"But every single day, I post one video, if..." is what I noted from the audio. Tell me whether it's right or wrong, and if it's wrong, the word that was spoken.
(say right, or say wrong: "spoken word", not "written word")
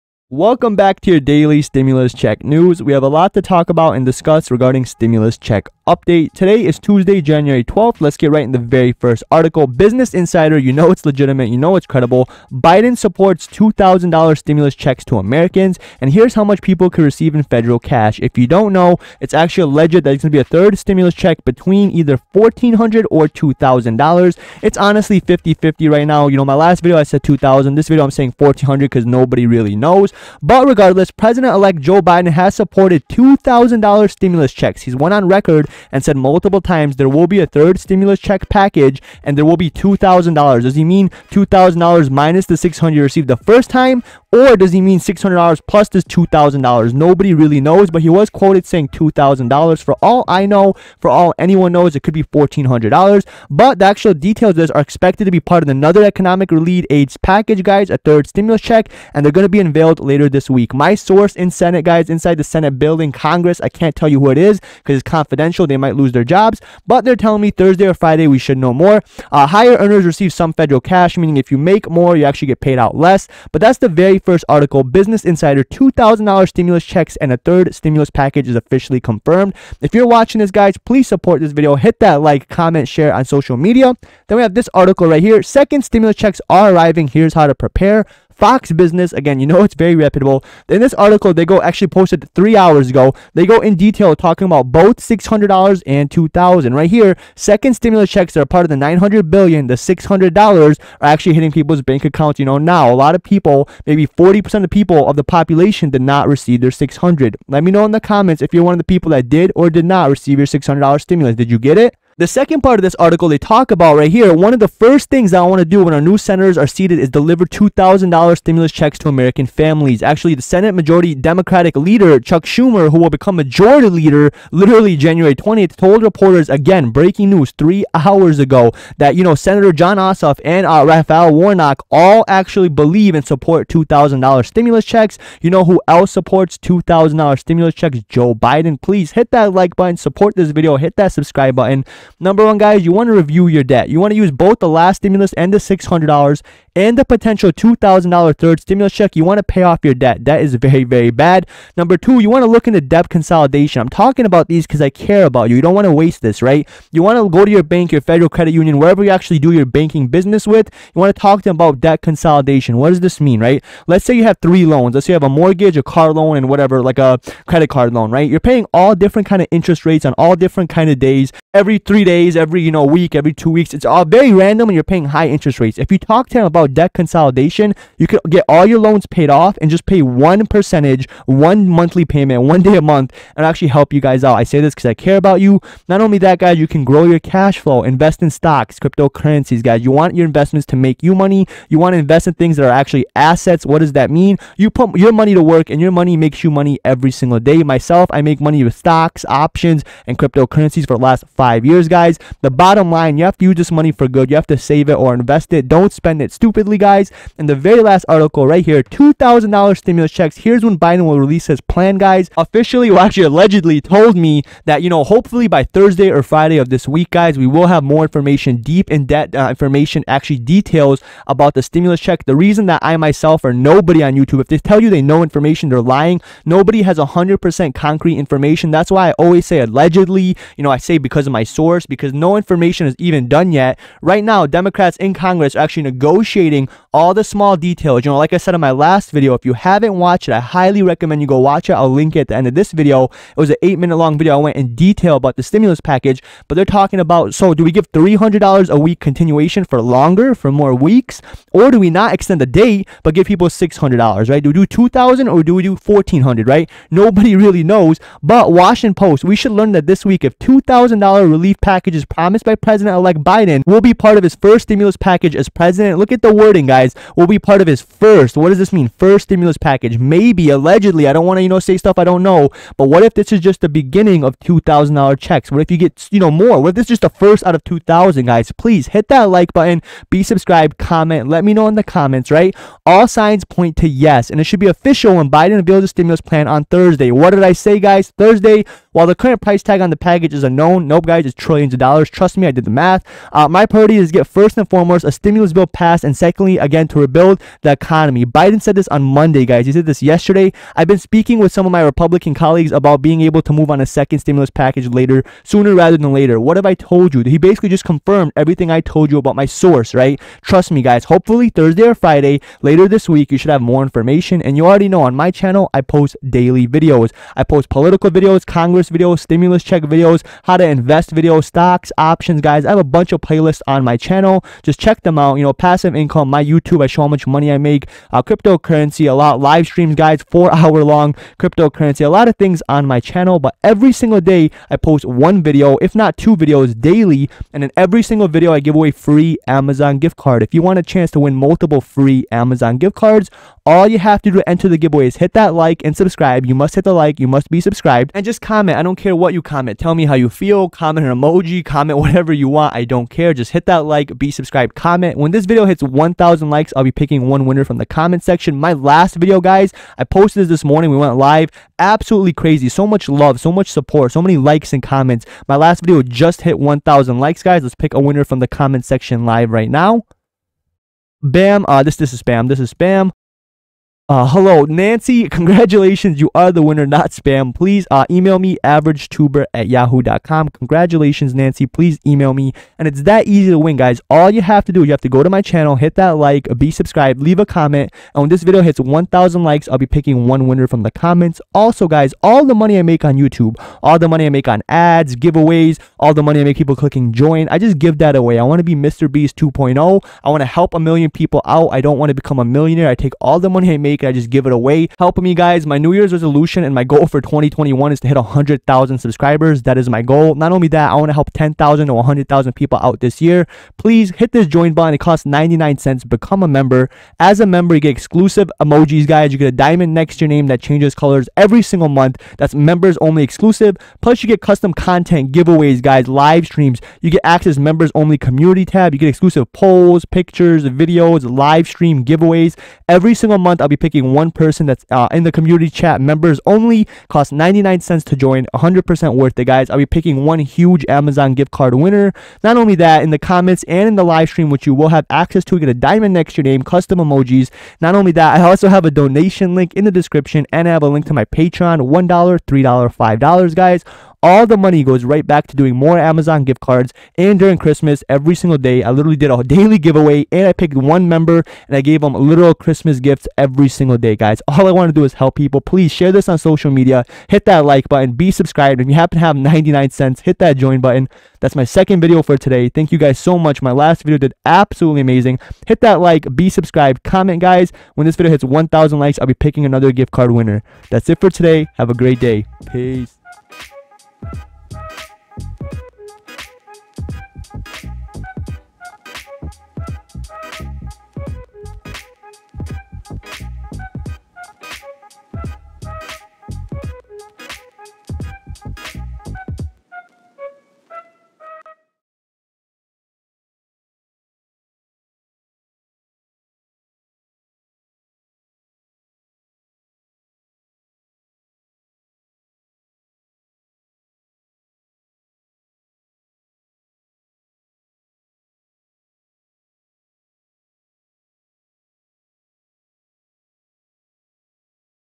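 right.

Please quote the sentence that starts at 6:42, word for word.
I take all the money I make could I just give it away?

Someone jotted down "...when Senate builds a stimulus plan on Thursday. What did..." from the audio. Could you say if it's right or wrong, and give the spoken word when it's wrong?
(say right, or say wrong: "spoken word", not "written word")
wrong: "Biden", not "Senate".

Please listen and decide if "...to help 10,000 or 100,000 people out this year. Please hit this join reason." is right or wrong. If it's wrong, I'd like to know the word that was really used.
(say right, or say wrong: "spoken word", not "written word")
wrong: "button", not "reason".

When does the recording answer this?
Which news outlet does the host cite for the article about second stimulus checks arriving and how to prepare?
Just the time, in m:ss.
1:28.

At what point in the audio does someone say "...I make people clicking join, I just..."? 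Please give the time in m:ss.
6:36.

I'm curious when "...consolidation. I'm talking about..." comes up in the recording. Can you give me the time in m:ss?
2:33.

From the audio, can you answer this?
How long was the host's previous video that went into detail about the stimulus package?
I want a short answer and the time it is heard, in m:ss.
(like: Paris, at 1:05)
8 minutes, at 4:03.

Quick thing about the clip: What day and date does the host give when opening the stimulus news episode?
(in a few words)
Tuesday, January 12th.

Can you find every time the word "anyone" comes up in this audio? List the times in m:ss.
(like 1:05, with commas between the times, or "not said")
0:51.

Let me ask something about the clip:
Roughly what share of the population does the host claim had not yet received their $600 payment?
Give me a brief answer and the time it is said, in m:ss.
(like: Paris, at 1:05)
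40%, at 1:44.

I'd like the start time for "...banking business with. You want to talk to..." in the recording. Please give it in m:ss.
2:39.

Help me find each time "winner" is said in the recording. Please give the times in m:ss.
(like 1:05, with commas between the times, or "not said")
5:57, 6:07, 6:16, 6:30, 7:21, 8:00.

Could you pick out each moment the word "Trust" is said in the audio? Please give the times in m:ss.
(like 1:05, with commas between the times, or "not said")
4:52, 5:10.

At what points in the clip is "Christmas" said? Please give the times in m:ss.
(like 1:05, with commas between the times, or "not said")
7:37, 7:42.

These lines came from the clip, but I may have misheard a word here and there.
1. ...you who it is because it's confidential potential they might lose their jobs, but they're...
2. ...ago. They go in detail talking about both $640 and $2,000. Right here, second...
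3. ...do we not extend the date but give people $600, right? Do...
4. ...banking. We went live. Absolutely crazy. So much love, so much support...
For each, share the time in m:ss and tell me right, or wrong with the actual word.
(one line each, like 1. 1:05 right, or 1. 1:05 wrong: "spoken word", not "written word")
1. 1:04 right
2. 1:32 wrong: "600", not "640"
3. 4:11 right
4. 6:00 wrong: "morning", not "banking".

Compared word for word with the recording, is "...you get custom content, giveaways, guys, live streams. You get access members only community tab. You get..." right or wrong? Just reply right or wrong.
right.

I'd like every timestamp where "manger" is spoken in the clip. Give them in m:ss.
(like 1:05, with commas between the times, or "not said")
not said.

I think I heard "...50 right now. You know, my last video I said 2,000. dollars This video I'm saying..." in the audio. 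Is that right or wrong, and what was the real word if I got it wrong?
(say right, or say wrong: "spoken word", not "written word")
right.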